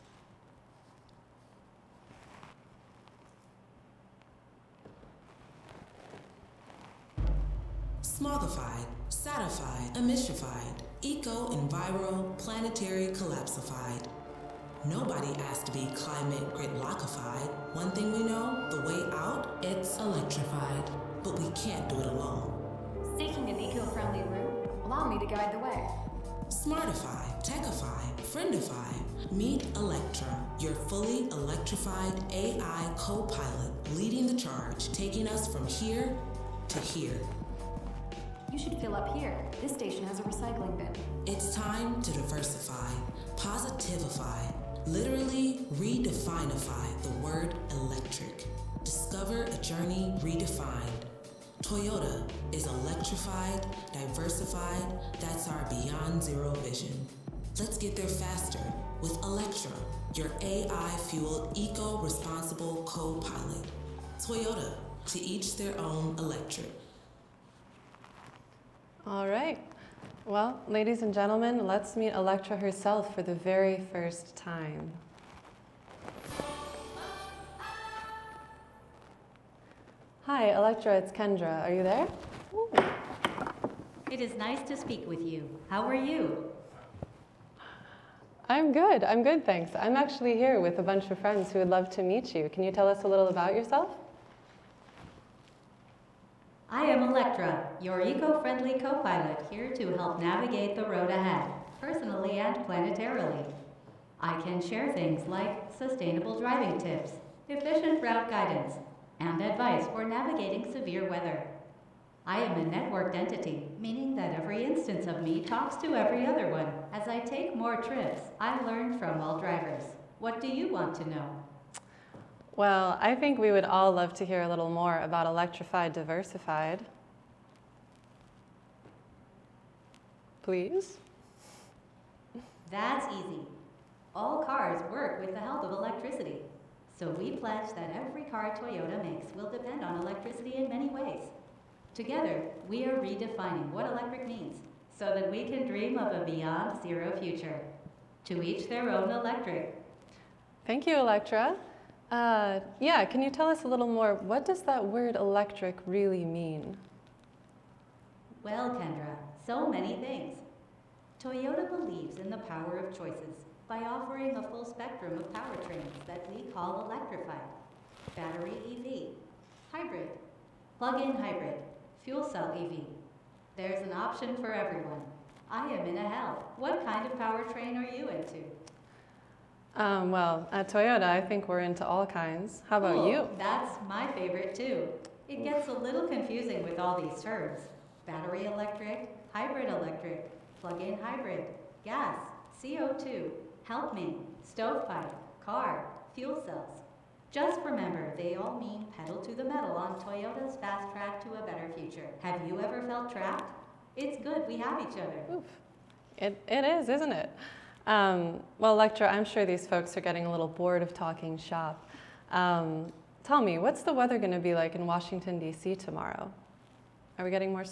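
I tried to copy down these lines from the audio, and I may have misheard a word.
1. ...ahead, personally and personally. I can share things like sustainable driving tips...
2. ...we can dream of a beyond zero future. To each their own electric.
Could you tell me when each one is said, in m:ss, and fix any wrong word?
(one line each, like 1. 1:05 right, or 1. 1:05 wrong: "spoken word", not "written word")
1. 1:41 wrong: "planetarily", not "personally"
2. 2:25 right.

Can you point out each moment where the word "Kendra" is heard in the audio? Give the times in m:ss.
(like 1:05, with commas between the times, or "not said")
1:21, 2:38.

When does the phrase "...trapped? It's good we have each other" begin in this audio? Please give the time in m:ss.
3:23.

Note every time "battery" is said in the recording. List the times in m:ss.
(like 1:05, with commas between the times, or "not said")
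2:48, 3:08.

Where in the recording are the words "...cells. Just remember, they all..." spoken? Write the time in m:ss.
3:16.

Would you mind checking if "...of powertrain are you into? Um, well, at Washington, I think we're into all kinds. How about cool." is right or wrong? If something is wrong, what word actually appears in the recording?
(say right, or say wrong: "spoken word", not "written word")
wrong: "Toyota", not "Washington".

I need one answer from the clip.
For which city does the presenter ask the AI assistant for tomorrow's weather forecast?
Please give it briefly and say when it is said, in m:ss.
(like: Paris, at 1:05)
Washington, D.C., at 3:34.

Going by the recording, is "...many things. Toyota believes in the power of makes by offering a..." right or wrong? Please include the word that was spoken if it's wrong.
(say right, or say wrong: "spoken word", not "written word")
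wrong: "choices", not "makes".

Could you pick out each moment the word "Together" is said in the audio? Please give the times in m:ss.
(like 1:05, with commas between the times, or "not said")
2:21.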